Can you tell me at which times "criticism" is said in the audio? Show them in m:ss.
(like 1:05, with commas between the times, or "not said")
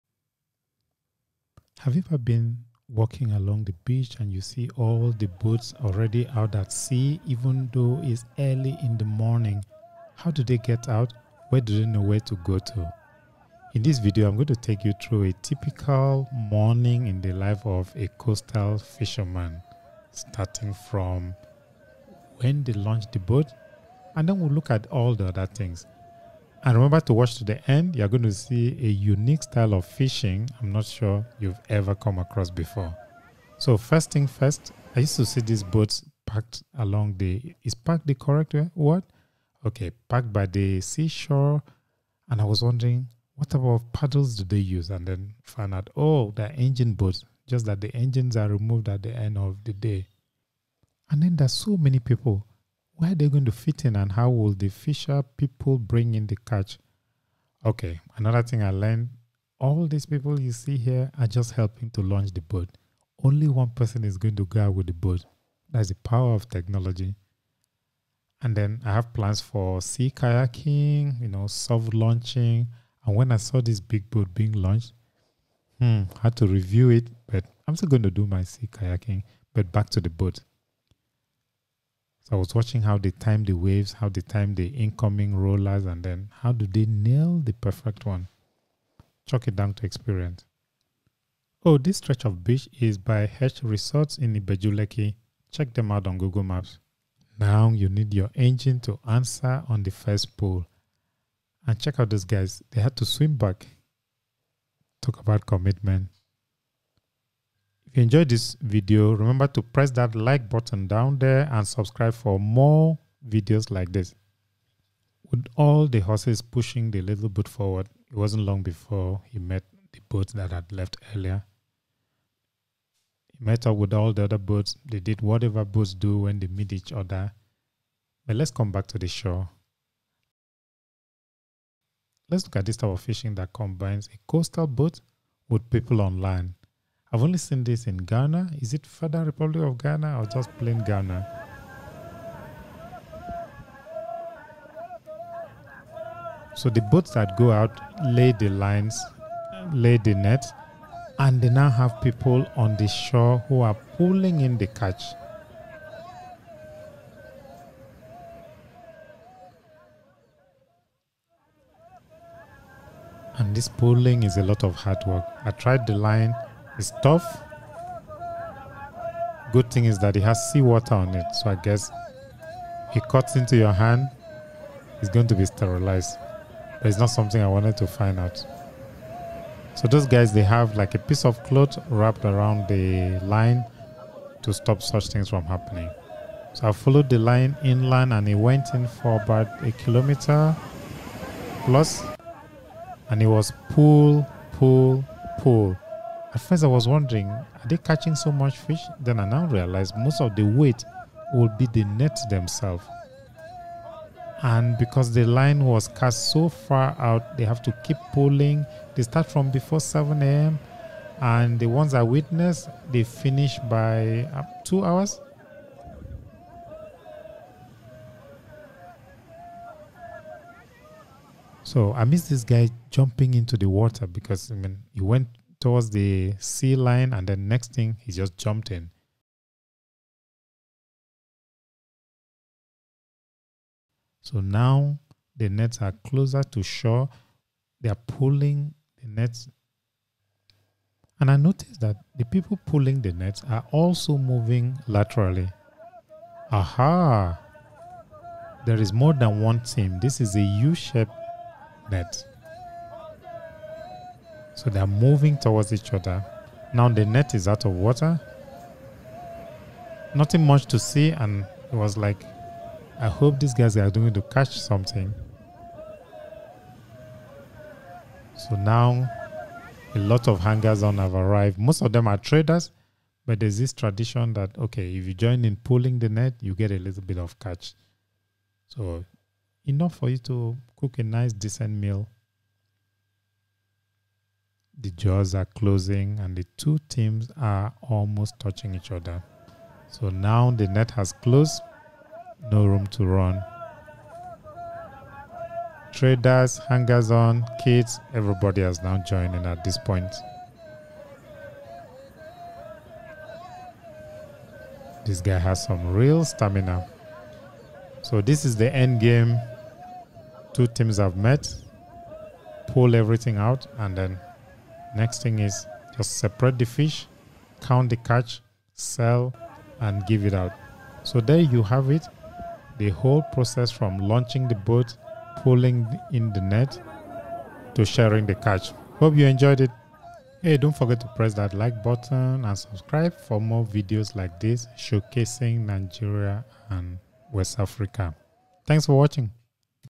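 not said.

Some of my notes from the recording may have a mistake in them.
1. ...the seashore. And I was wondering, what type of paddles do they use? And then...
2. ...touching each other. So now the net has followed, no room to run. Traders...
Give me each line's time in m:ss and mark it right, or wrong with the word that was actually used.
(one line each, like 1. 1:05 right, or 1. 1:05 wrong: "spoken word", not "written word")
1. 0:40 right
2. 4:48 wrong: "closed", not "followed".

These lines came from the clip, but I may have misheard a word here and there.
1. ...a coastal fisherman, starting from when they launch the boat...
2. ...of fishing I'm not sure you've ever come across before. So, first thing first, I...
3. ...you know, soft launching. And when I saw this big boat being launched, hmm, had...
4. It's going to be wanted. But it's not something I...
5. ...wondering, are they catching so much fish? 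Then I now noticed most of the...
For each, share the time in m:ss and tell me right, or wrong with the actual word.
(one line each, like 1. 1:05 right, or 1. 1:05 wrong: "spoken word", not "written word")
1. 0:17 right
2. 0:29 right
3. 1:11 right
4. 2:54 wrong: "sterilized", not "wanted"
5. 3:16 wrong: "realized", not "noticed".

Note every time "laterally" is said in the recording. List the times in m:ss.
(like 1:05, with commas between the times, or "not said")
4:04.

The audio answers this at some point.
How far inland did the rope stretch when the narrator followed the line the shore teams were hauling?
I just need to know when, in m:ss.
3:09.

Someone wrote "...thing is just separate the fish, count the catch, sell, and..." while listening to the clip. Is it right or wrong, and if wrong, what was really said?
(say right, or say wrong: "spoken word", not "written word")
right.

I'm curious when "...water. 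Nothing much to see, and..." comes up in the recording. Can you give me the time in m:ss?
4:17.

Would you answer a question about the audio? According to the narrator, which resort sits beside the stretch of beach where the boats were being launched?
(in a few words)
H Resorts.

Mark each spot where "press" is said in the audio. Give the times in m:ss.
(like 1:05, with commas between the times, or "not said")
1:49, 5:31.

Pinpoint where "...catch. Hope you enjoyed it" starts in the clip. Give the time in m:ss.
5:28.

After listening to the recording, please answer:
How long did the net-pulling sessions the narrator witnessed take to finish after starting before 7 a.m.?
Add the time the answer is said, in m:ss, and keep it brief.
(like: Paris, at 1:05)
2 hours, at 3:34.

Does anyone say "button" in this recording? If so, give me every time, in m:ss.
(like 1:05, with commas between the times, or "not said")
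1:50, 5:31.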